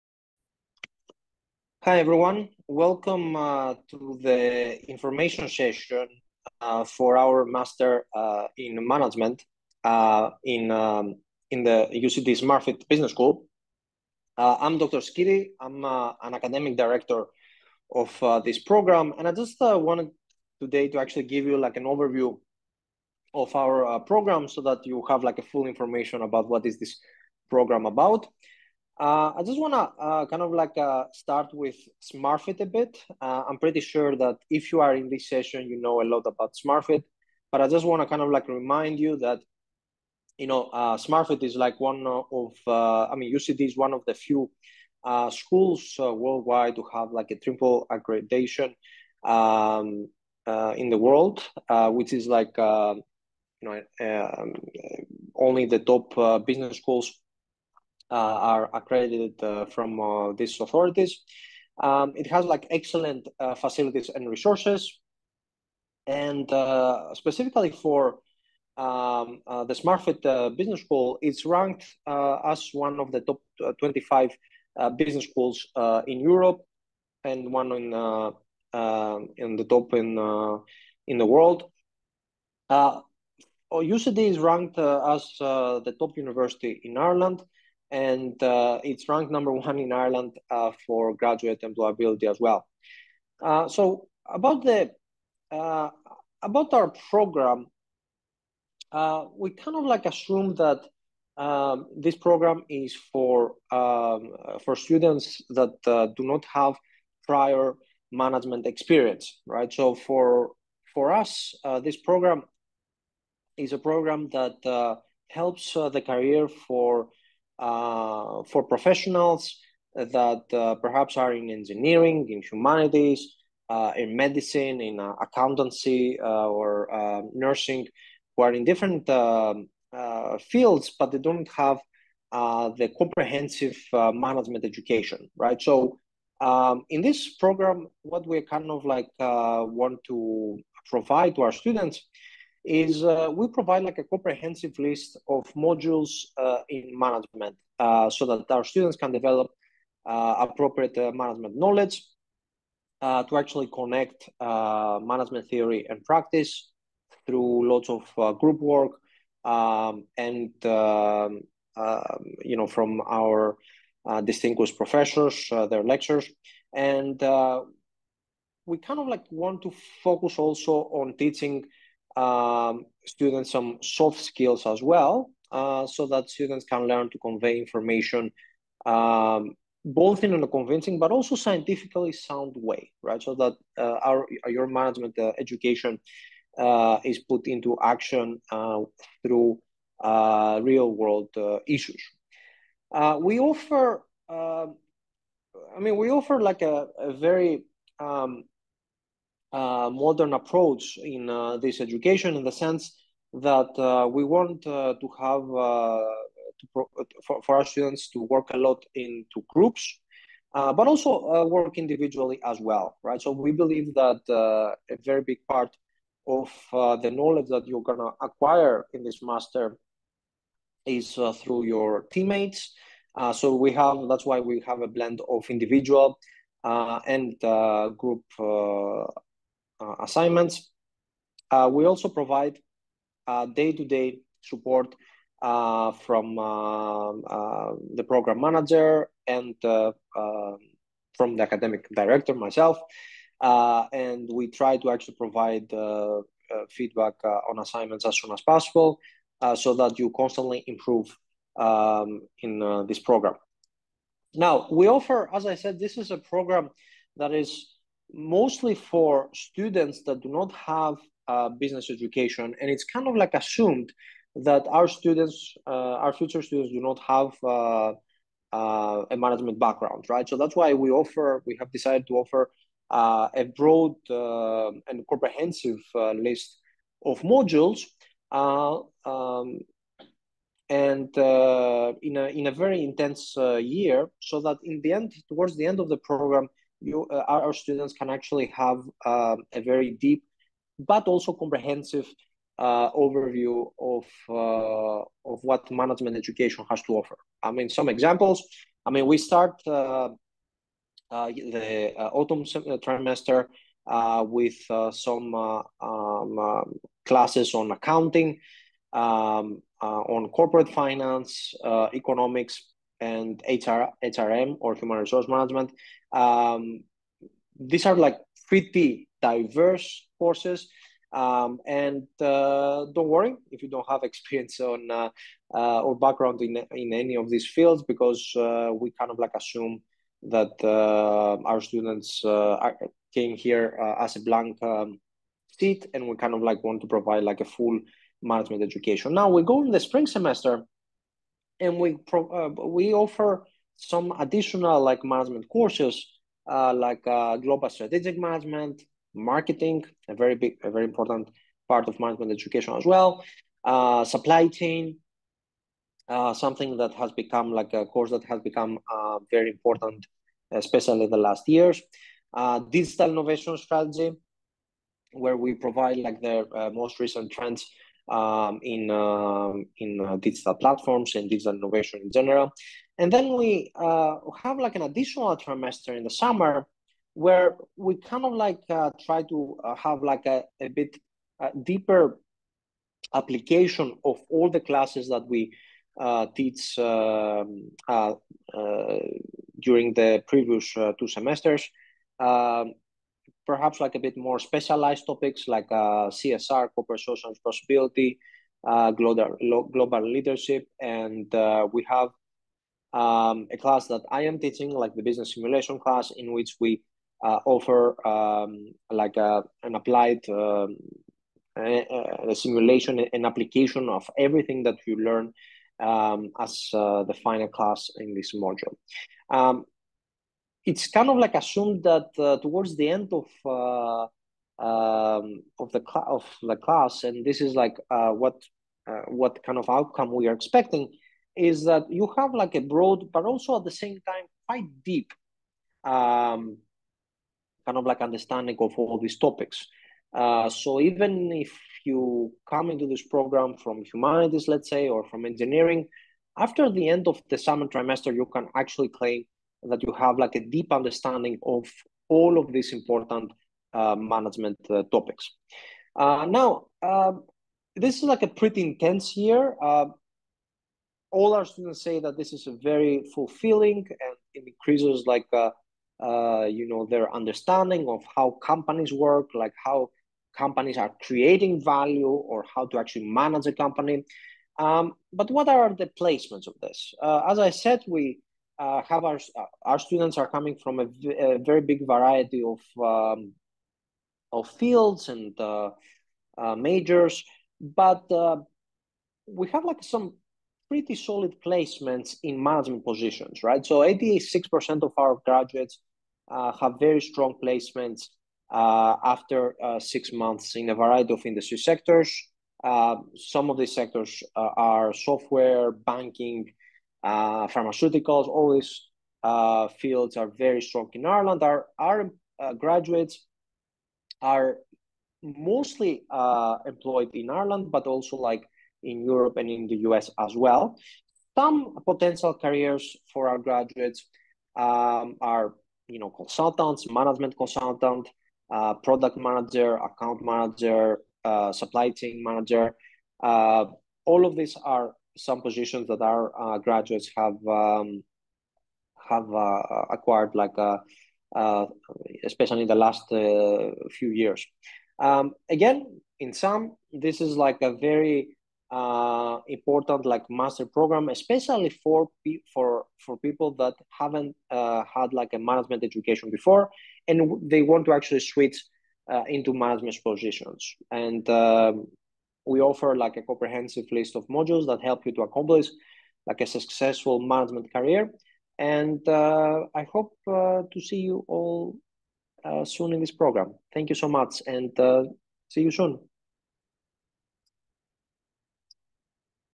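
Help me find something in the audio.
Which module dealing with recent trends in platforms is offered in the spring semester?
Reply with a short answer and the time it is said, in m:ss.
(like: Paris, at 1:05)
digital innovation strategy, at 6:02.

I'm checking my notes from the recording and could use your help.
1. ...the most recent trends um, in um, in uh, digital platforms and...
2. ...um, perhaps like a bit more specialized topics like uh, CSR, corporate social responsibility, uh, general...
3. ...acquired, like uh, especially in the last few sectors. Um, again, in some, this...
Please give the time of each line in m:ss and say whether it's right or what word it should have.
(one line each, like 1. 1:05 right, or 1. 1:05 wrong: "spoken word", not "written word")
1. 6:06 right
2. 6:32 wrong: "global", not "general"
3. 8:59 wrong: "years", not "sectors".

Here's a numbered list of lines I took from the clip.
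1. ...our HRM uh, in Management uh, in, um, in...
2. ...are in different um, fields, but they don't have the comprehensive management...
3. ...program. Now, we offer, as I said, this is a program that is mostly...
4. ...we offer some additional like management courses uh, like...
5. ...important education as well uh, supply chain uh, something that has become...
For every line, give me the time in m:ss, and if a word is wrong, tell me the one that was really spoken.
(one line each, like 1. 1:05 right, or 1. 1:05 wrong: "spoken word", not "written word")
1. 0:07 wrong: "Master", not "HRM"
2. 2:08 right
3. 4:12 right
4. 5:42 right
5. 5:51 wrong: "management", not "important".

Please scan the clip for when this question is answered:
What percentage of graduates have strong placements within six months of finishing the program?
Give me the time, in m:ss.
8:13.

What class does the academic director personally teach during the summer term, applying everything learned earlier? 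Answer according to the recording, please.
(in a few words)
business simulation.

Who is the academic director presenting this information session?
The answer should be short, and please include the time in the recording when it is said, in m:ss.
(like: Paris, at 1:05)
Dr. Skiti, at 0:14.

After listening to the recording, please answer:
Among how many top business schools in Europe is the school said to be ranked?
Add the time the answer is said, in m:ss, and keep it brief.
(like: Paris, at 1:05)
25, at 1:13.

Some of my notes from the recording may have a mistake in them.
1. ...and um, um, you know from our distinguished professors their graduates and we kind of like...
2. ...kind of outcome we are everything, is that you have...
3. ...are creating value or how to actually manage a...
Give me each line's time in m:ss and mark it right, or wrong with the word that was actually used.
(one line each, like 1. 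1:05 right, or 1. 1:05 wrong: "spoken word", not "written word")
1. 2:40 wrong: "lectures", not "graduates"
2. 7:09 wrong: "expecting", not "everything"
3. 7:50 right.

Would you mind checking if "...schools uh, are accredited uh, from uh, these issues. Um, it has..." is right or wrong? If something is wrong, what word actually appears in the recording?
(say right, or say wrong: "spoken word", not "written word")
wrong: "authorities", not "issues".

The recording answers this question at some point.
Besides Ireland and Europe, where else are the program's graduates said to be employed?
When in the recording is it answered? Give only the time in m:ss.
8:39.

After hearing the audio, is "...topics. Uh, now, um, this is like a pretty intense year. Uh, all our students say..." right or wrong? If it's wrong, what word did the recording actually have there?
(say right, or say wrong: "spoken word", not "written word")
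right.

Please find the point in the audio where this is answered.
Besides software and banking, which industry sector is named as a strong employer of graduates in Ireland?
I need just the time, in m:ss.
8:27.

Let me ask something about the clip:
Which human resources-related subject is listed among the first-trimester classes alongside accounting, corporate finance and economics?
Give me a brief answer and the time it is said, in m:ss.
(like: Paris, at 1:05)
human resource management, at 5:14.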